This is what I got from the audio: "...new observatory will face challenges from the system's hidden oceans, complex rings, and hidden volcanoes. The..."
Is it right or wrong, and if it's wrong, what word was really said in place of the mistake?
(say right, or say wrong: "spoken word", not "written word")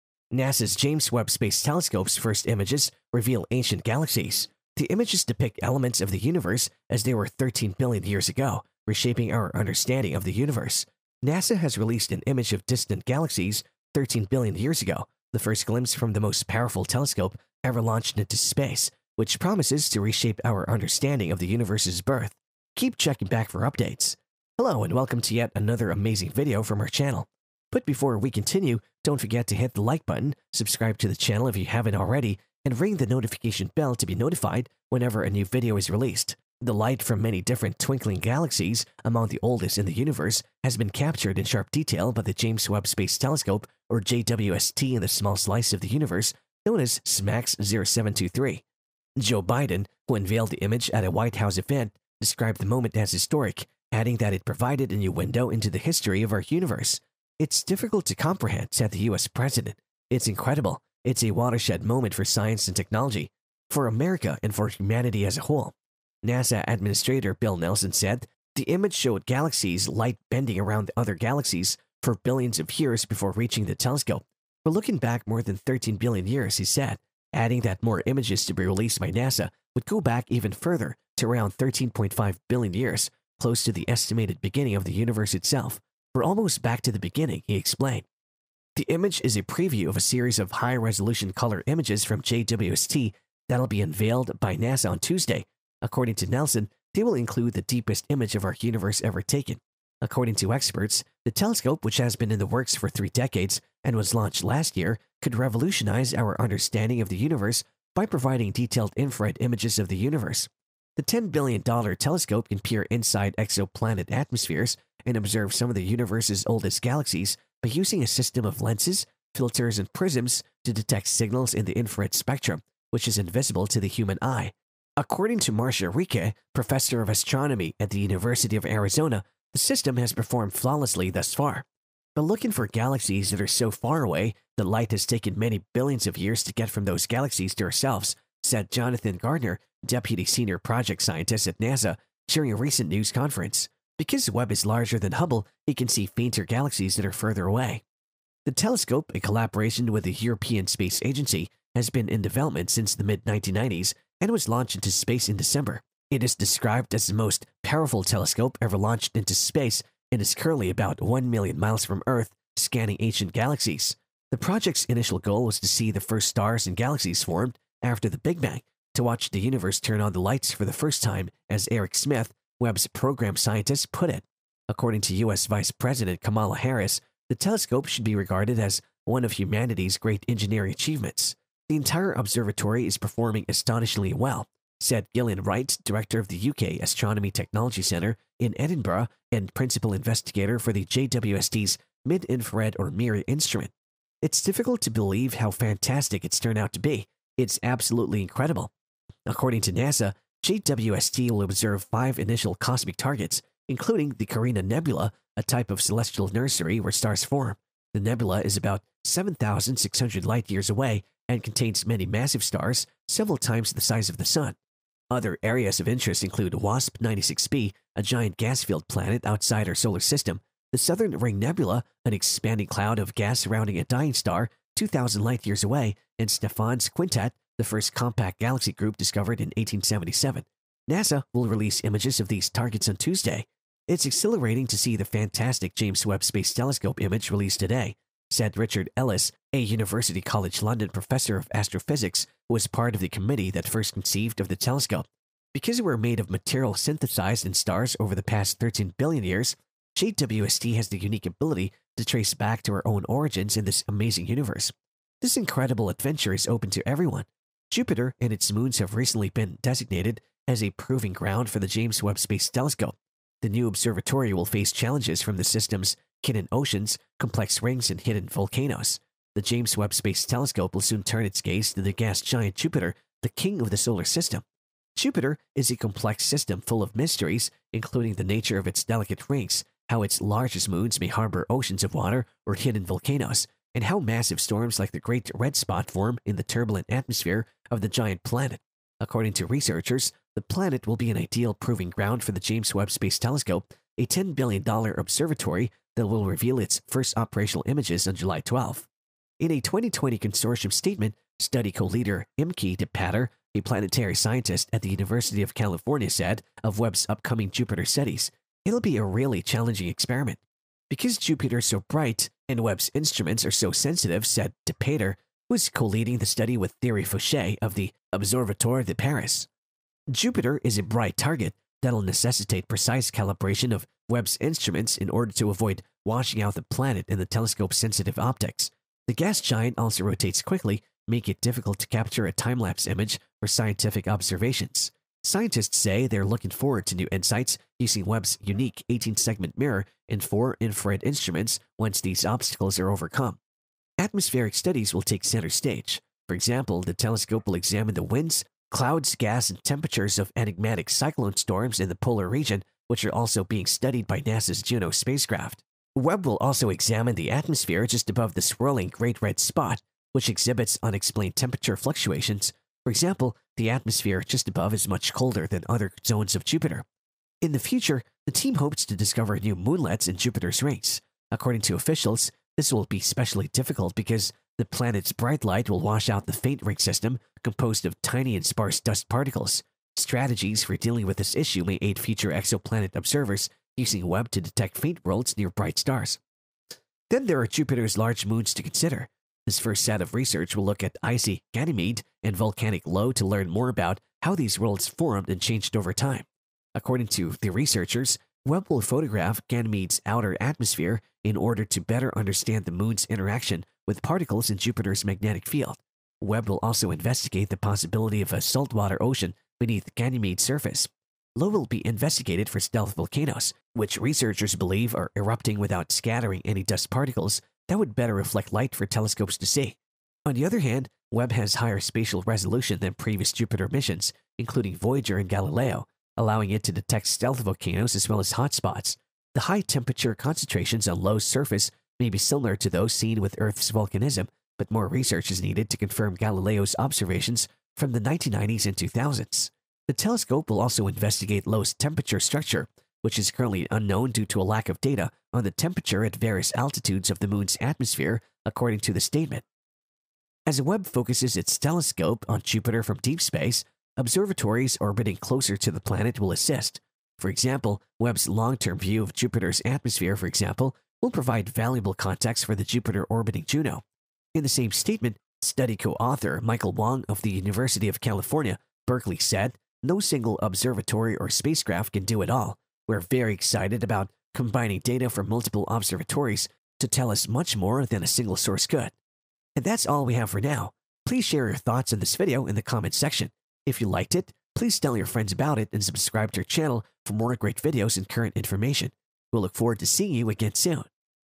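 right.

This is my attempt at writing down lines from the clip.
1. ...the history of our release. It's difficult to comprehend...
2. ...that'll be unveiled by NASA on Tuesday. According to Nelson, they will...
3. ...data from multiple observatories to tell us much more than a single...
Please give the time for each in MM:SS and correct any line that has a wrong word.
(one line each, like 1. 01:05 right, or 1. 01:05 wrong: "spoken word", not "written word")
1. 00:55 wrong: "universe", not "release"
2. 01:33 right
3. 07:54 right.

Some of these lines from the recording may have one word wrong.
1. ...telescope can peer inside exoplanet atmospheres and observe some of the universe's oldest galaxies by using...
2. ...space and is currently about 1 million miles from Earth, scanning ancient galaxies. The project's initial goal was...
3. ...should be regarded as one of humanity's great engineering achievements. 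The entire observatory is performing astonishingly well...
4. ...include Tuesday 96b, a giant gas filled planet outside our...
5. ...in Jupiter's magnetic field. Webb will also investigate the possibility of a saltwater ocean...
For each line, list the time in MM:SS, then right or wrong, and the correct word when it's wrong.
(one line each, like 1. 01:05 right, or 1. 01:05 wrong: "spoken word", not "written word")
1. 01:51 right
2. 02:39 right
3. 02:57 right
4. 03:36 wrong: "WASP", not "Tuesday"
5. 06:44 right.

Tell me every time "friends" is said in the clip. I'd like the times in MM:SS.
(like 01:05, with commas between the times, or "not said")
08:05.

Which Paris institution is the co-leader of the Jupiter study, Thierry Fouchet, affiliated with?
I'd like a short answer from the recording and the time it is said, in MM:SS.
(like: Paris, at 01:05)
Observatoire de Paris, at 05:18.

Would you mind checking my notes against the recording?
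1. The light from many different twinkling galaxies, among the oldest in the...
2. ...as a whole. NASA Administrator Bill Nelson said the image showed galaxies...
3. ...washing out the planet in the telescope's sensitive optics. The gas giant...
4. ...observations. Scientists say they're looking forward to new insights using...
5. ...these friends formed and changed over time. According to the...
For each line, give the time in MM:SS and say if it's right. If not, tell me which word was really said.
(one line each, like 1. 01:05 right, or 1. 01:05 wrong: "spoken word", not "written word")
1. 00:36 right
2. 01:05 right
3. 05:26 right
4. 05:34 right
5. 06:34 wrong: "worlds", not "friends".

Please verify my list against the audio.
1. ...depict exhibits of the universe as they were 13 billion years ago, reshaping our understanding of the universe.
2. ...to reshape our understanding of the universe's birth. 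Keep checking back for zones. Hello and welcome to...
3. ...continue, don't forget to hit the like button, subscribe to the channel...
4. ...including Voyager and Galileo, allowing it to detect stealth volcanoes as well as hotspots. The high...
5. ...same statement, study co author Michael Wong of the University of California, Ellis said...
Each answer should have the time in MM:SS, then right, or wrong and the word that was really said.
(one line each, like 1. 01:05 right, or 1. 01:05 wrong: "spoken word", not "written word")
1. 00:05 wrong: "elements", not "exhibits"
2. 00:19 wrong: "updates", not "zones"
3. 00:28 right
4. 07:04 right
5. 07:44 wrong: "Berkeley", not "Ellis".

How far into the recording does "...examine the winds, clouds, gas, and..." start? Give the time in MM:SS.
05:47.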